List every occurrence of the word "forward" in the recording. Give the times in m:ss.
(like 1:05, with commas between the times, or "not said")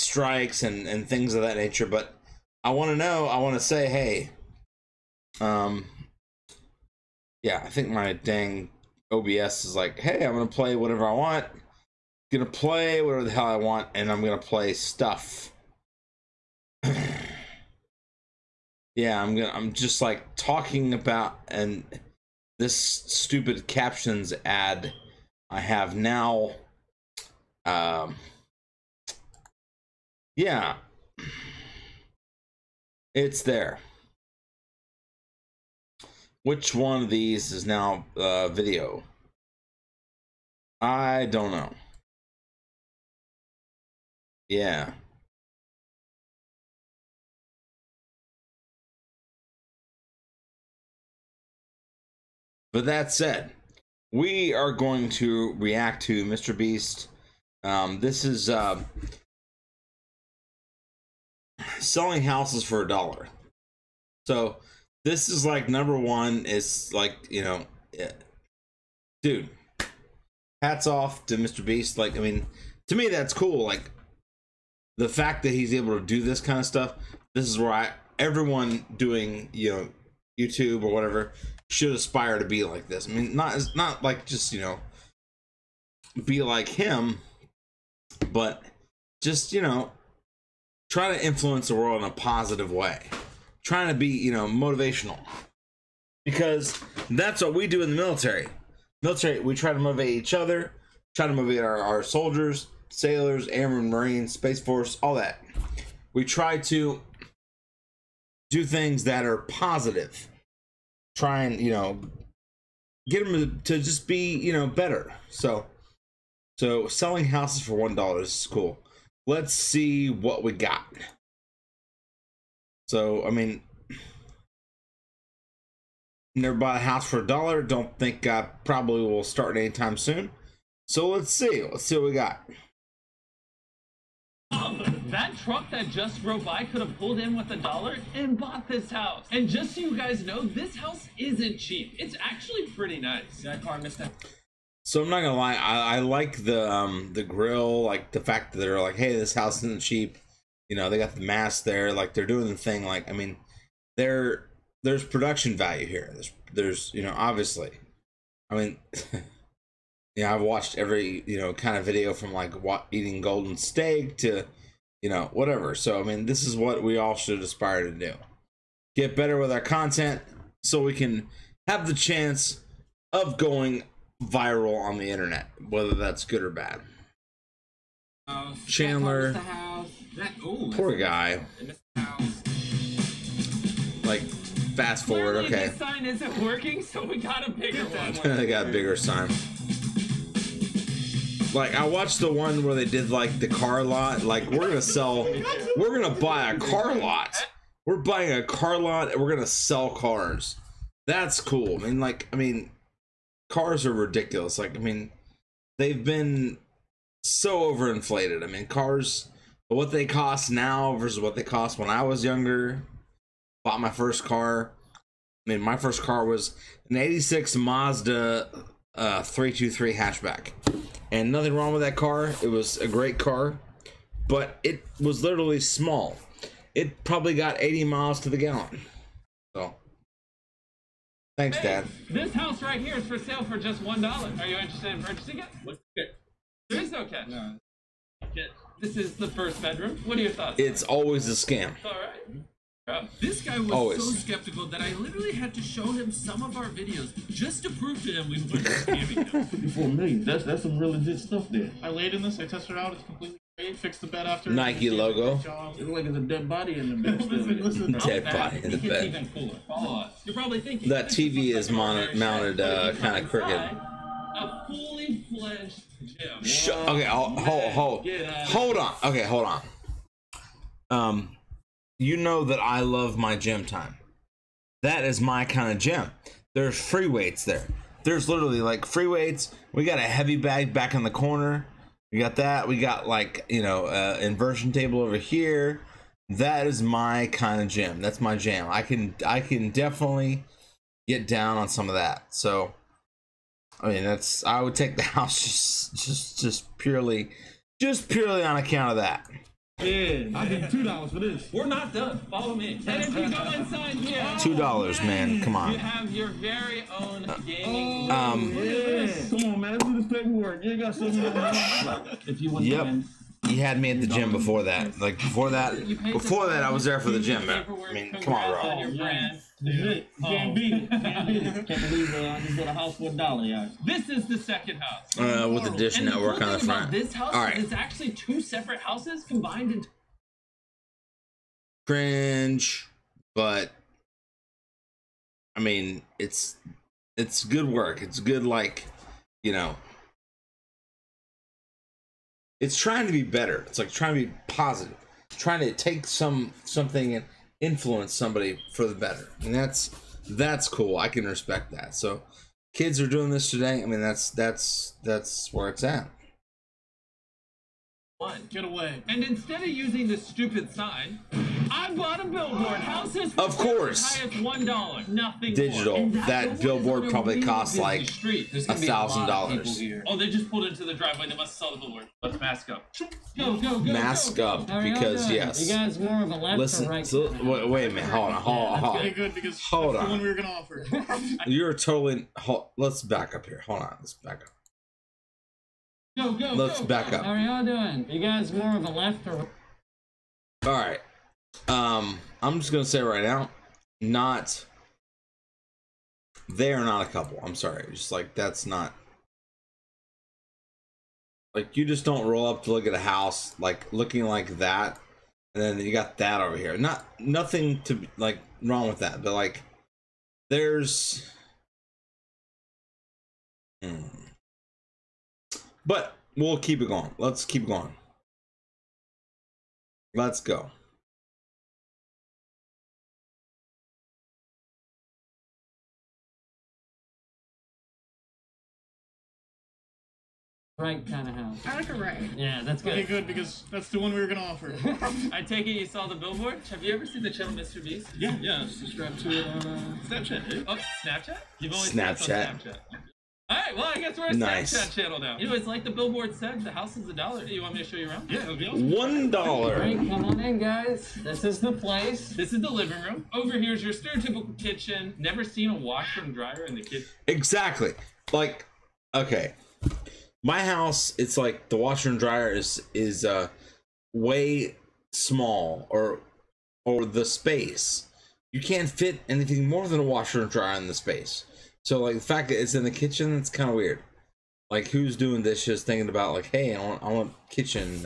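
3:05.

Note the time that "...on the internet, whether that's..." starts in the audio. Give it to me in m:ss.
2:54.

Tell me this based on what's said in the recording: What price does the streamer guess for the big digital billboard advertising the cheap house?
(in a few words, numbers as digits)
$1,000.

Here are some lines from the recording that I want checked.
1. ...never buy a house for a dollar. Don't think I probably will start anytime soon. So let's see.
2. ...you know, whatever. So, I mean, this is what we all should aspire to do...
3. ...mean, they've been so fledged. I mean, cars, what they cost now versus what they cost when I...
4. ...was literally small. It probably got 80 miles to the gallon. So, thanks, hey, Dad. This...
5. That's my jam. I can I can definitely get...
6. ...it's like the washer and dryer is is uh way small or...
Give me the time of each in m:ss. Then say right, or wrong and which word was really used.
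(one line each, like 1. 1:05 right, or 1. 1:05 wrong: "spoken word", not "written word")
1. 2:06 right
2. 2:45 right
3. 3:24 wrong: "overinflated", not "fledged"
4. 3:44 right
5. 4:48 right
6. 7:41 right.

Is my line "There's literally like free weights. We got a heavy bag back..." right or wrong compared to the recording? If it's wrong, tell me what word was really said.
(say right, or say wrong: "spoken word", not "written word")
right.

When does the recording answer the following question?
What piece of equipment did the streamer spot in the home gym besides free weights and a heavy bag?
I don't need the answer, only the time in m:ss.
4:44.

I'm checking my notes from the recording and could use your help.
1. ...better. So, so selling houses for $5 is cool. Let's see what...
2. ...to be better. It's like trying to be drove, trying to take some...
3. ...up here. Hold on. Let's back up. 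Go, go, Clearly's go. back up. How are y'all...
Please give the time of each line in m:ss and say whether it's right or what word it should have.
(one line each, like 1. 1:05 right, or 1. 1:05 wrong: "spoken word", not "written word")
1. 1:54 wrong: "1", not "5"
2. 5:43 wrong: "positive", not "drove"
3. 6:23 wrong: "Let", not "Clearly".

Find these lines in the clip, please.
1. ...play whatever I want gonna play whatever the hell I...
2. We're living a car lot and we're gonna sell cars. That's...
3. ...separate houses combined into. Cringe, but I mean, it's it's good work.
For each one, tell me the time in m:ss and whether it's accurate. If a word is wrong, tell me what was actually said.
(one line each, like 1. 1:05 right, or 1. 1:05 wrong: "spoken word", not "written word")
1. 0:10 right
2. 3:17 wrong: "buying", not "living"
3. 5:28 right.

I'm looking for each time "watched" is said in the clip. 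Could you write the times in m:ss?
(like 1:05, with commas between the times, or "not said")
2:40, 3:11.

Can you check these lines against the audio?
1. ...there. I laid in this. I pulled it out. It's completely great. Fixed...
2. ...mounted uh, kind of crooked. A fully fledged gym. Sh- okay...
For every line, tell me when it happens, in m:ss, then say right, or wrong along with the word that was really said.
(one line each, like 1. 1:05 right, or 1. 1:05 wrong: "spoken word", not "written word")
1. 4:11 wrong: "tested", not "pulled"
2. 4:22 right.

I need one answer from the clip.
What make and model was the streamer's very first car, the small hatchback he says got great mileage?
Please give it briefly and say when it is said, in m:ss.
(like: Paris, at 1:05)
Mazda 323, at 3:37.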